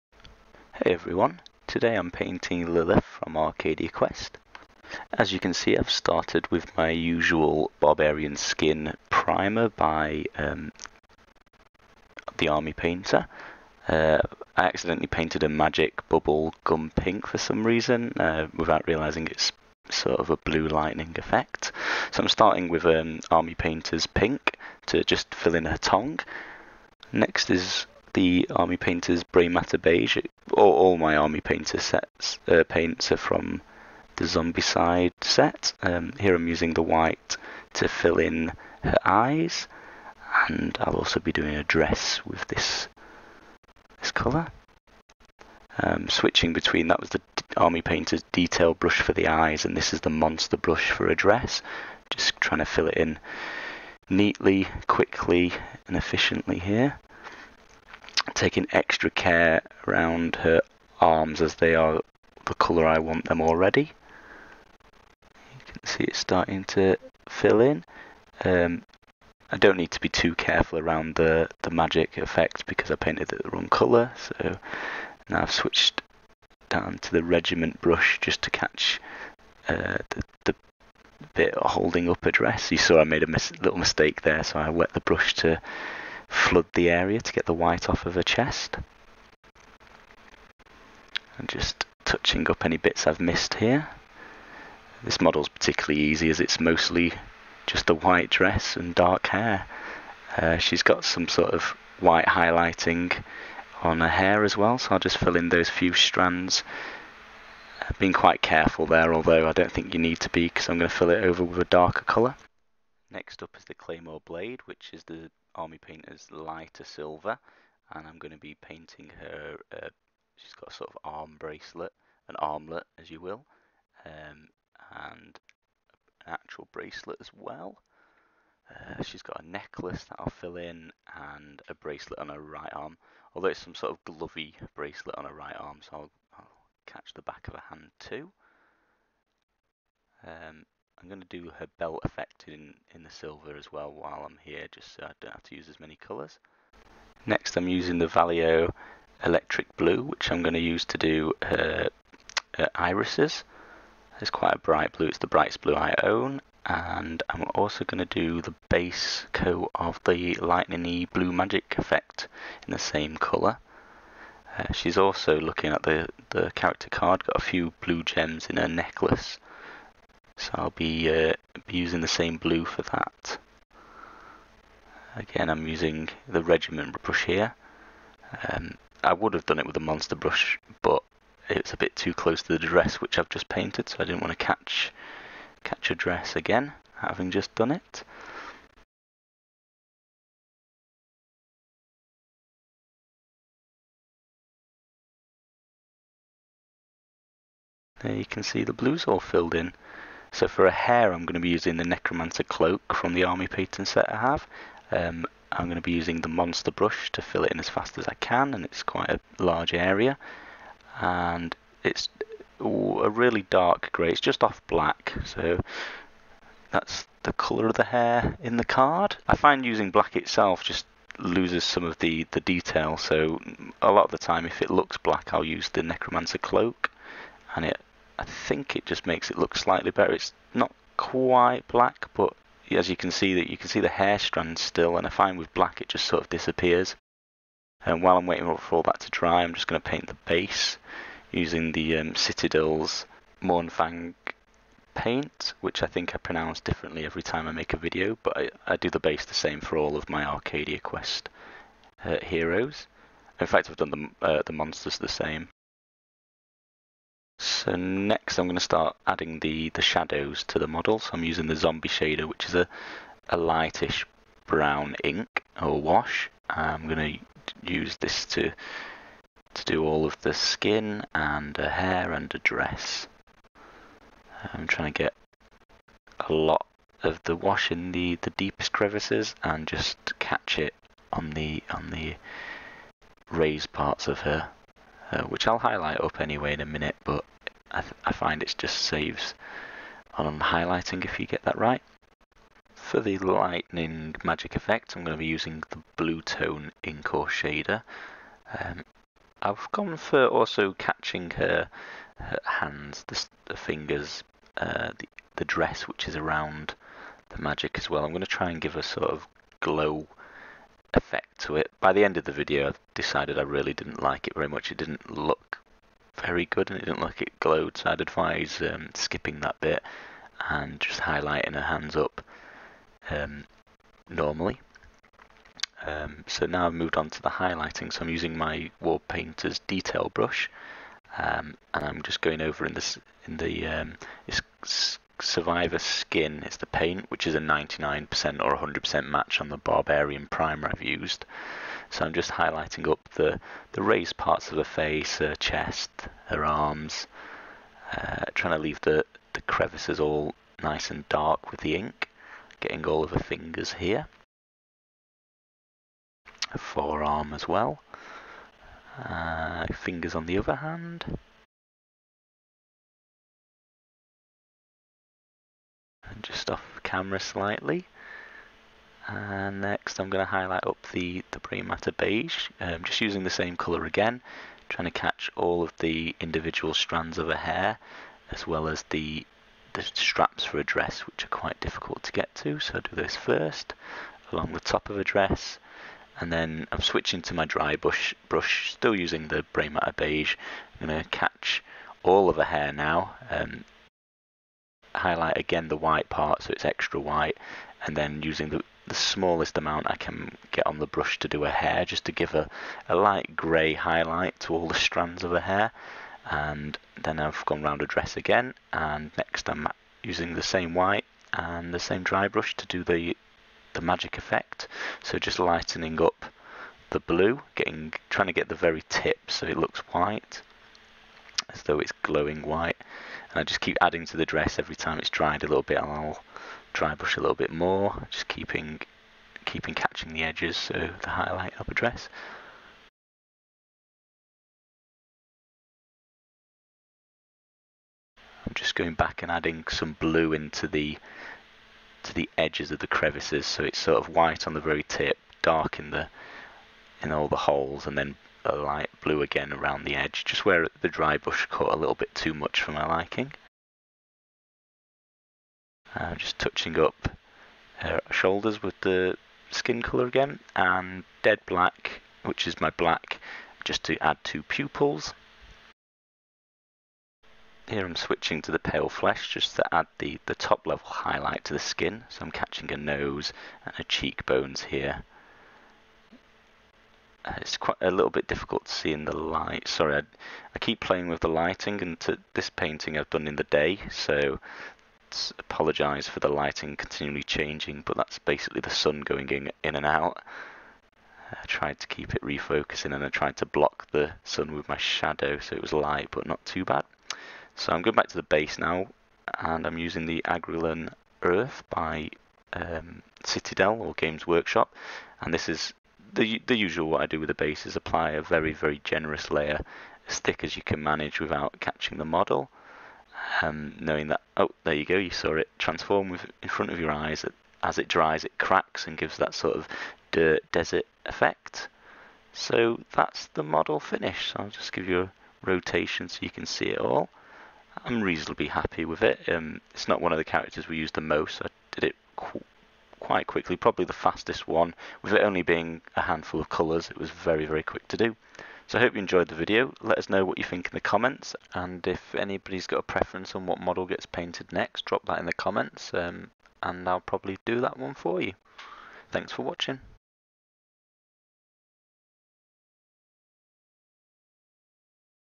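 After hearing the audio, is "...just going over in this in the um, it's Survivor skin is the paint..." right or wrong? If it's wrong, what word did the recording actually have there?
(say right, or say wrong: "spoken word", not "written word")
right.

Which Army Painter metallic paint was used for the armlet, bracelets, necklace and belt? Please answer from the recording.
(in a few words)
Claymore Blade.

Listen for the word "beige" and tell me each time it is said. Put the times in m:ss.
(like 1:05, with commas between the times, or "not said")
0:29, 6:11, 6:29.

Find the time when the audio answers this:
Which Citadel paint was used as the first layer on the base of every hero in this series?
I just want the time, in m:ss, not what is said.
4:03.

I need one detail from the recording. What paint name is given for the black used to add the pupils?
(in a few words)
dead black.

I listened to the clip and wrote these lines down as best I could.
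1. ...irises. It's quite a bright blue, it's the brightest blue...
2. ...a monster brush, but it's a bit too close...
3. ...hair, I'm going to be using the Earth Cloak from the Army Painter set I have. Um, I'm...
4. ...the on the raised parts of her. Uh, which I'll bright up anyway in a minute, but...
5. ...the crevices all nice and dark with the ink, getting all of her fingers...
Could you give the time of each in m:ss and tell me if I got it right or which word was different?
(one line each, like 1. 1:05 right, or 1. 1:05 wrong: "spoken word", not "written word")
1. 2:32 right
2. 2:59 right
3. 3:20 wrong: "Necromancer", not "Earth"
4. 4:41 wrong: "highlight", not "bright"
5. 5:49 right.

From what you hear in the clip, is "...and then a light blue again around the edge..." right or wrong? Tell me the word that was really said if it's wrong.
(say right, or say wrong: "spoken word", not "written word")
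right.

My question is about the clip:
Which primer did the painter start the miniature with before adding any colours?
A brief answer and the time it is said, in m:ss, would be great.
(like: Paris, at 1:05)
Barbarian Skin, at 0:07.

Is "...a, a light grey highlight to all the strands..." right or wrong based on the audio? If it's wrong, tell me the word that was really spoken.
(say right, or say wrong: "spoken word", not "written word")
right.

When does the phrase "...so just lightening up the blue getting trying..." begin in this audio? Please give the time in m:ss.
6:55.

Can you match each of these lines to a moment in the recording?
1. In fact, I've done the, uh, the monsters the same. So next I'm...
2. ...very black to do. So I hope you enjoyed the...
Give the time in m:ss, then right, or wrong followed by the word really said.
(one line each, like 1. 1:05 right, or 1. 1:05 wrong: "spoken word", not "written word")
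1. 4:13 right
2. 8:57 wrong: "quick", not "black".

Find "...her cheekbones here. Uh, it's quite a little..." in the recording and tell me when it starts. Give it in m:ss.
7:53.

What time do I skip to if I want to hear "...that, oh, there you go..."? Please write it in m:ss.
8:34.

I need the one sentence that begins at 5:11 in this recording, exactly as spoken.
By the end of the video, I decided I really didn't like it very much.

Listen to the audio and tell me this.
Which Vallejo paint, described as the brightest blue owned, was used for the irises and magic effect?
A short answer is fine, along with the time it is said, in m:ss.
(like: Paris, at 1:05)
Electric Blue, at 2:29.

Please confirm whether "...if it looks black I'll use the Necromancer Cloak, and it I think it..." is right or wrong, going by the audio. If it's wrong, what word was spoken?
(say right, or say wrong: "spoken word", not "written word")
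right.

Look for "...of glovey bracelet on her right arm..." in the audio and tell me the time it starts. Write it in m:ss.
2:13.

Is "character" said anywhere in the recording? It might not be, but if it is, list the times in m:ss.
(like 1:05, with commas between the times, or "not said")
2:46, 8:50.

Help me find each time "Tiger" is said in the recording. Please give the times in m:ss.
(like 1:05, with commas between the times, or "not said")
not said.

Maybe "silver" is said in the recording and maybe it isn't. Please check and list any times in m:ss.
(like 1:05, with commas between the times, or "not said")
1:56, 2:23.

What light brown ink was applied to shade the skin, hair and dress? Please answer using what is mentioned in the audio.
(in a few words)
zombie shader.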